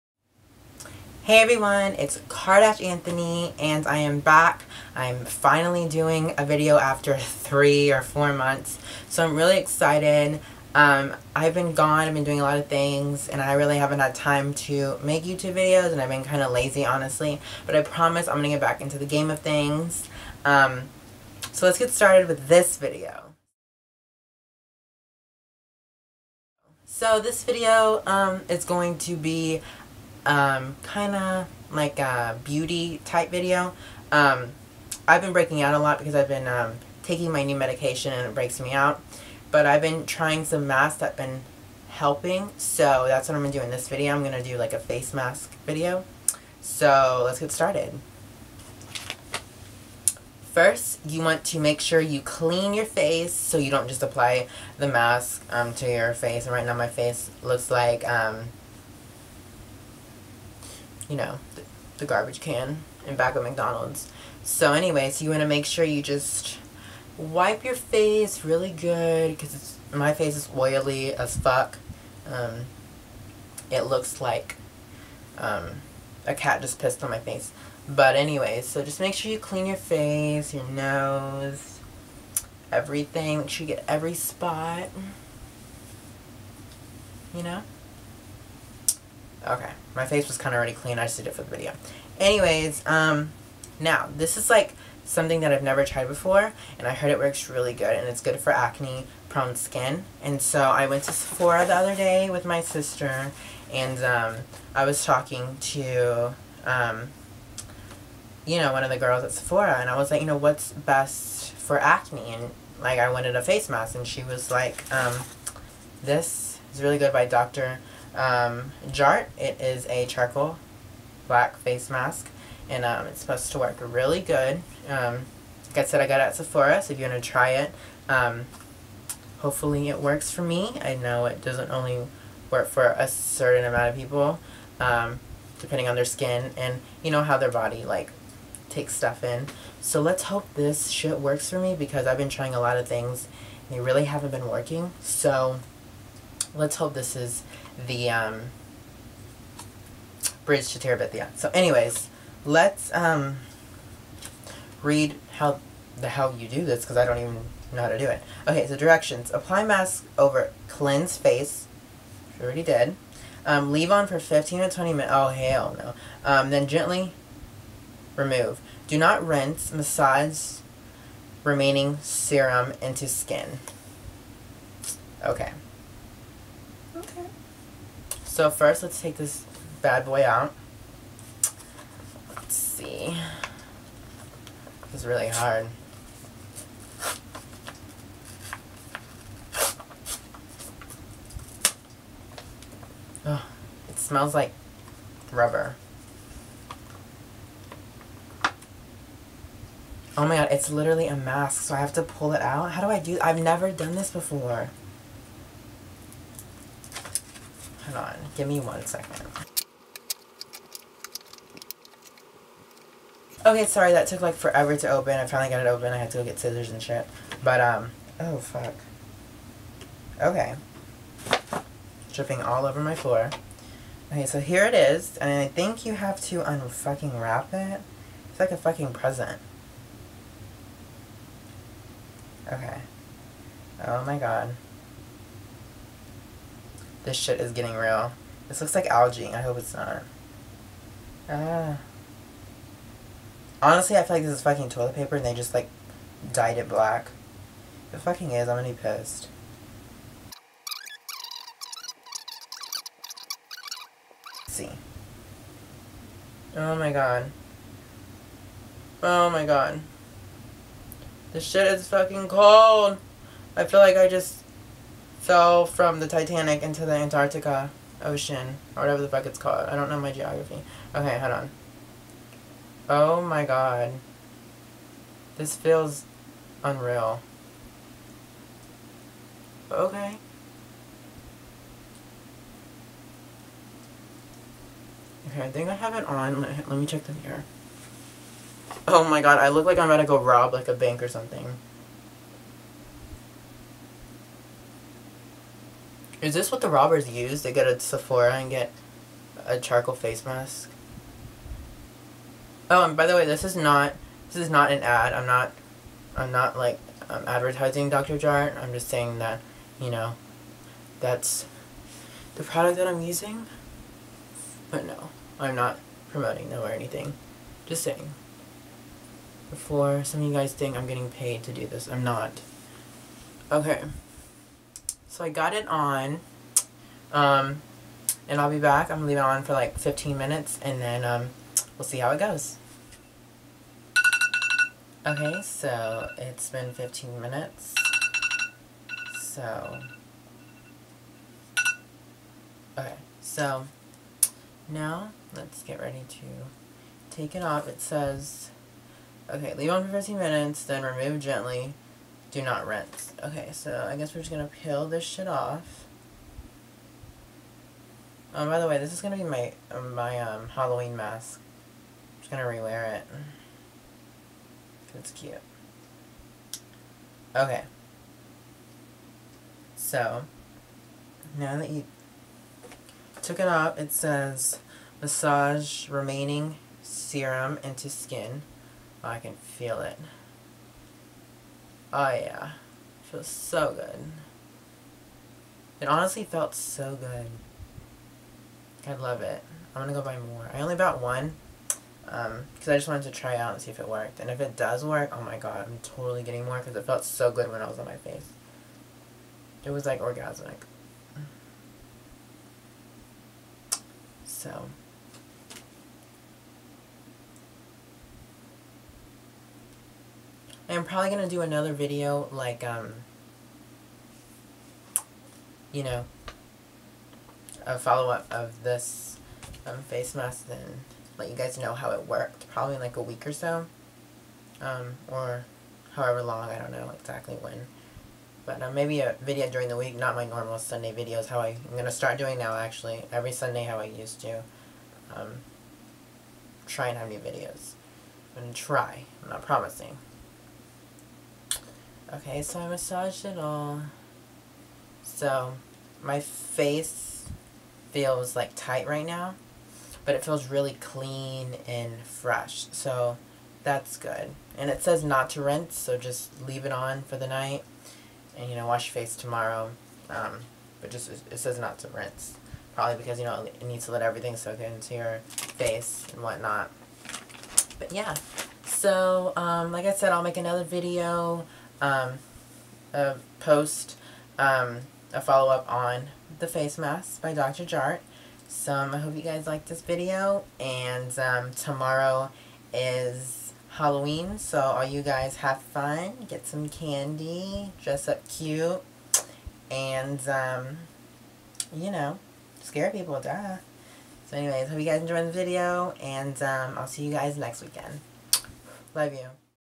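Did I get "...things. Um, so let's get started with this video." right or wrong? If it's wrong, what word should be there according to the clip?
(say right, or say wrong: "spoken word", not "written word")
right.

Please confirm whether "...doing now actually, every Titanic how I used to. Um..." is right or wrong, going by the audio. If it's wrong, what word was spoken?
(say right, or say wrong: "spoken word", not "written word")
wrong: "Sunday", not "Titanic".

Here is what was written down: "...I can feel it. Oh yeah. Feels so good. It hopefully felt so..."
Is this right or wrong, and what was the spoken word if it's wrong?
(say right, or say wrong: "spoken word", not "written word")
wrong: "honestly", not "hopefully".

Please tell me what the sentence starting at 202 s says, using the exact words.
How do I do I've never done this before.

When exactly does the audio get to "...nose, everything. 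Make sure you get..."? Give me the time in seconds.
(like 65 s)
80 s.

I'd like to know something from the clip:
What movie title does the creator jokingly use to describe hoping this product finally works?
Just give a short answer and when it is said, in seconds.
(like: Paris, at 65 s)
Bridge to Terabithia, at 150 s.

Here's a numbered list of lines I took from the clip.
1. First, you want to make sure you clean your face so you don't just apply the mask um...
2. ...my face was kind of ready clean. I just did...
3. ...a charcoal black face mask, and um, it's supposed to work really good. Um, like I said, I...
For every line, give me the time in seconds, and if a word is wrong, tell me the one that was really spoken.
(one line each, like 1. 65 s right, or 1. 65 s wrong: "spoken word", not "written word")
1. 50 s right
2. 89 s wrong: "already", not "ready"
3. 119 s right.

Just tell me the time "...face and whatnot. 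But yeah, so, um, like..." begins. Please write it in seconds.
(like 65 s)
465 s.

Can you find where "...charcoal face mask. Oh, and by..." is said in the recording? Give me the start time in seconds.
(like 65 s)
299 s.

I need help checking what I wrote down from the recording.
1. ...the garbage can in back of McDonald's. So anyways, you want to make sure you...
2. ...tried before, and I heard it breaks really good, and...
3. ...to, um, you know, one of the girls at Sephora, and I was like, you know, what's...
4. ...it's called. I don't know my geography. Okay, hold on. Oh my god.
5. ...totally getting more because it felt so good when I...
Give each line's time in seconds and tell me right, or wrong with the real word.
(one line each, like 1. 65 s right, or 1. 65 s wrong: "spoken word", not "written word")
1. 61 s right
2. 95 s wrong: "works", not "breaks"
3. 105 s right
4. 269 s right
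5. 395 s right.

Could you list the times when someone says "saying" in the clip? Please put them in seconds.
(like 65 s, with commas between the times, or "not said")
308 s, 317 s.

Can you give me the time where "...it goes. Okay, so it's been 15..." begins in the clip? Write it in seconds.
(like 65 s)
332 s.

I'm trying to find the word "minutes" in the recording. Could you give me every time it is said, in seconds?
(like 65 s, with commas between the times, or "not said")
164 s, 330 s, 337 s, 350 s.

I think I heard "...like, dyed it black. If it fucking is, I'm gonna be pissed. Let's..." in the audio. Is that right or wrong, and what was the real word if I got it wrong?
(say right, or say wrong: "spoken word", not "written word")
right.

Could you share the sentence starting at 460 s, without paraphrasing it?
Um, but just, it says not to rinse.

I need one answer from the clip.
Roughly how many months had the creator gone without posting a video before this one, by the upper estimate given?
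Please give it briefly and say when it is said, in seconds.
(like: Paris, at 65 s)
4, at 8 s.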